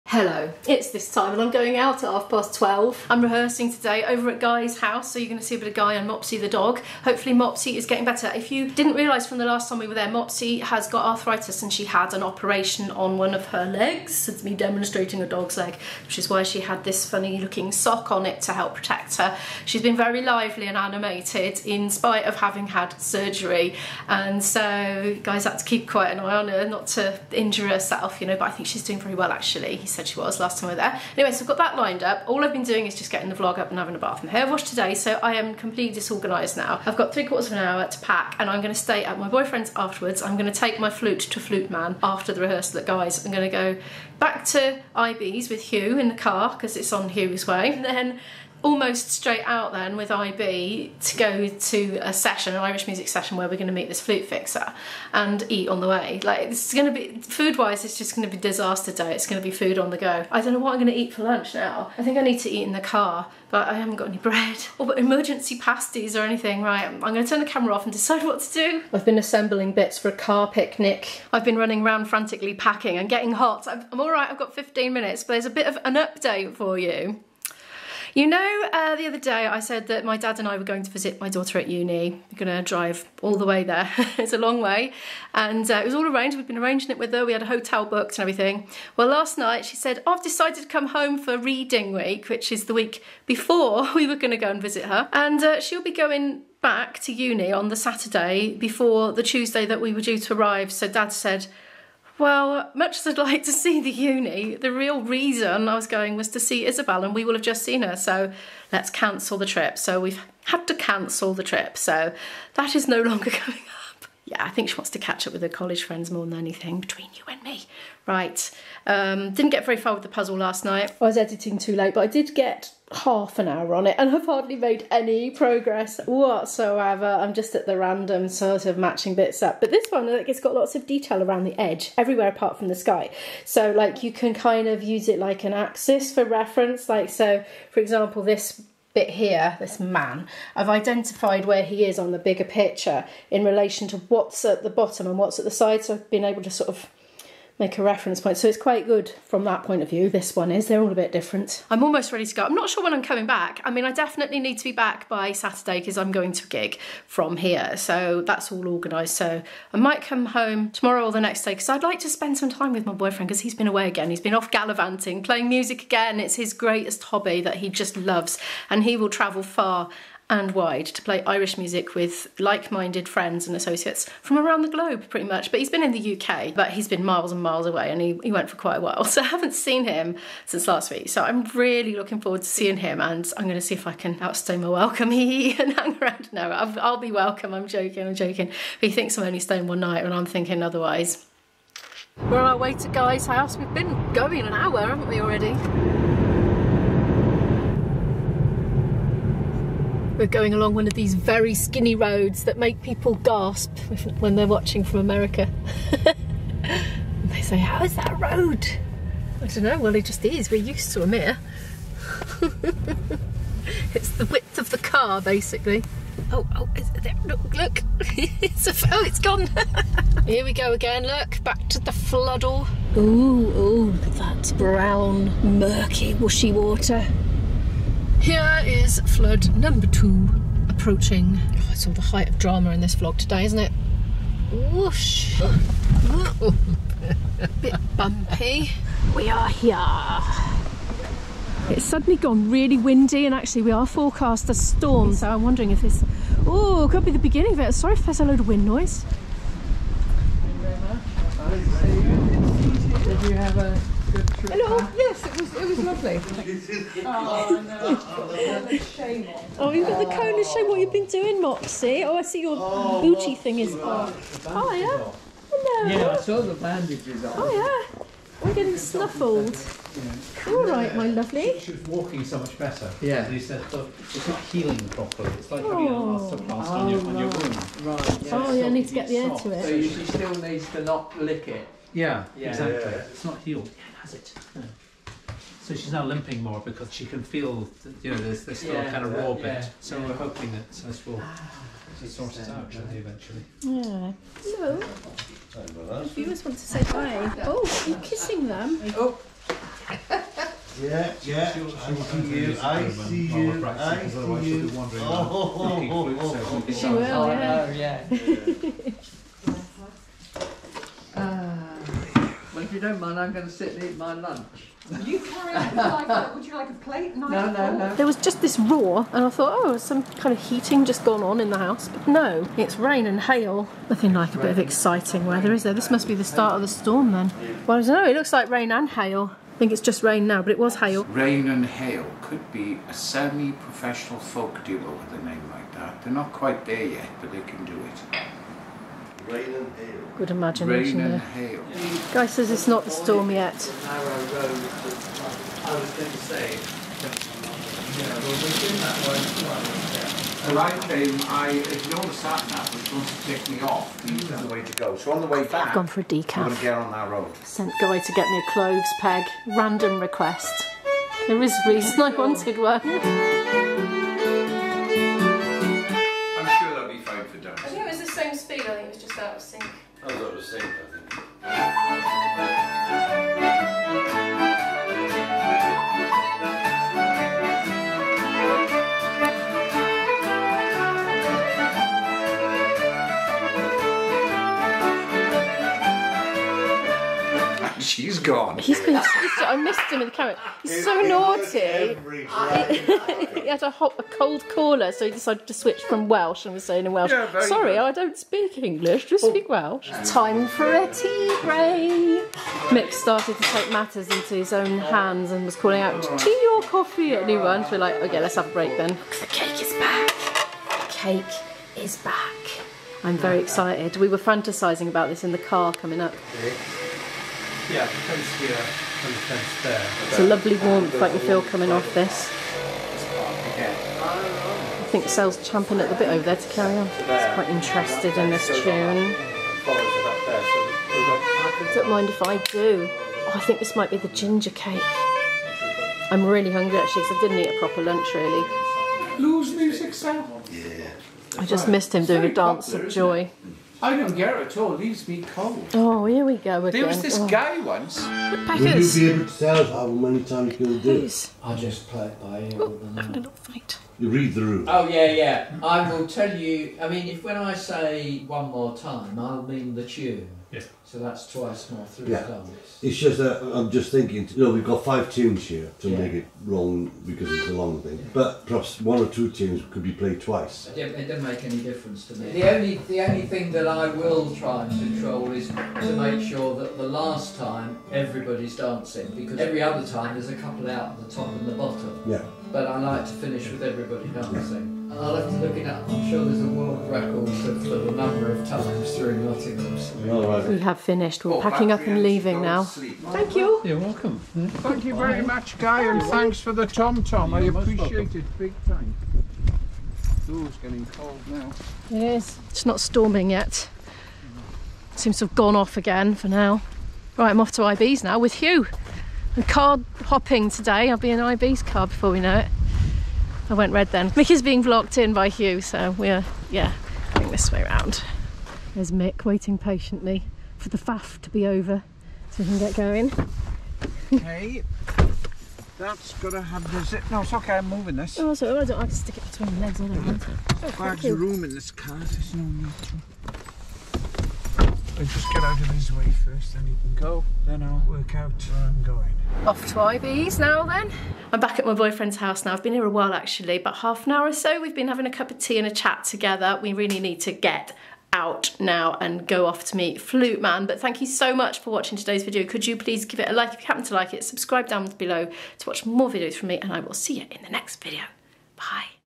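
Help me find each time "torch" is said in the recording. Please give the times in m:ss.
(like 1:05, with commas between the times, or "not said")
not said.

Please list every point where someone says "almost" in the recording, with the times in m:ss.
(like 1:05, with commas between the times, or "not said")
0:48, 2:31.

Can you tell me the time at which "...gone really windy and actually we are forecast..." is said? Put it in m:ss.
4:02.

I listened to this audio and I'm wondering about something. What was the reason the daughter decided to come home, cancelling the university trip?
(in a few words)
reading week.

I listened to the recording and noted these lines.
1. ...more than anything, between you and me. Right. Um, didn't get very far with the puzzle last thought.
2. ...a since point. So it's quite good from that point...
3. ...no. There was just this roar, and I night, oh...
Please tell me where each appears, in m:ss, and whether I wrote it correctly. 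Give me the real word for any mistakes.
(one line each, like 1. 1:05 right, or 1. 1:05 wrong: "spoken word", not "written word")
1. 1:56 wrong: "night", not "thought"
2. 2:27 wrong: "reference", not "since"
3. 5:17 wrong: "thought", not "night".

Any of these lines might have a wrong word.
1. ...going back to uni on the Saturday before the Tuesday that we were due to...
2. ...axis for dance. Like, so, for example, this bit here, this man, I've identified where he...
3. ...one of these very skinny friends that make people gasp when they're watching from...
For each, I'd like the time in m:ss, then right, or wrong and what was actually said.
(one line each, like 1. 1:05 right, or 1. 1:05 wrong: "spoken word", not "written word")
1. 1:35 right
2. 2:15 wrong: "reference", not "dance"
3. 3:20 wrong: "roads", not "friends".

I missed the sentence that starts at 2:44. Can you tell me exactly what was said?
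He's been off gallivanting, playing music again.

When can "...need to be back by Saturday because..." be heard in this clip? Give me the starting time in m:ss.
2:34.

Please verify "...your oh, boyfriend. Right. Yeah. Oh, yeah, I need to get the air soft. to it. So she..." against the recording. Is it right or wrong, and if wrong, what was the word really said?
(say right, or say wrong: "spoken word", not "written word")
wrong: "wound", not "boyfriend".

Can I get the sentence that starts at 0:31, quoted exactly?
Anyway, so I've got that lined up.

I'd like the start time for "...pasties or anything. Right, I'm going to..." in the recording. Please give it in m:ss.
1:05.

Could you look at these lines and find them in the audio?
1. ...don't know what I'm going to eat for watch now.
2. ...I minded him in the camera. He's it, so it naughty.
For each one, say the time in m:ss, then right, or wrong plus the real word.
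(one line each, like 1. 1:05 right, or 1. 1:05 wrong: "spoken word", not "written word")
1. 1:00 wrong: "lunch", not "watch"
2. 6:29 wrong: "missed", not "minded".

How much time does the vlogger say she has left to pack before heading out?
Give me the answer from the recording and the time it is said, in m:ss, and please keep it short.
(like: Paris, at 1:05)
three quarters of an hour, at 0:37.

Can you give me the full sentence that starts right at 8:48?
Oh, so I don't like to stick it between the legs, I don't want to.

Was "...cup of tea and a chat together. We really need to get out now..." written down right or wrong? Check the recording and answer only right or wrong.
right.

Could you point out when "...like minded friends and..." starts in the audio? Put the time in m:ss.
2:52.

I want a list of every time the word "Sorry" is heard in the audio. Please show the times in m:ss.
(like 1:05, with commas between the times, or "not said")
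4:07, 4:55, 6:37.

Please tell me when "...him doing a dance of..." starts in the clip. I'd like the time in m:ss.
7:21.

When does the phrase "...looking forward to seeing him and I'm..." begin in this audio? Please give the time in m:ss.
3:01.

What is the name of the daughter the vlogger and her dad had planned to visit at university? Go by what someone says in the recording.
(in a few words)
Isabel.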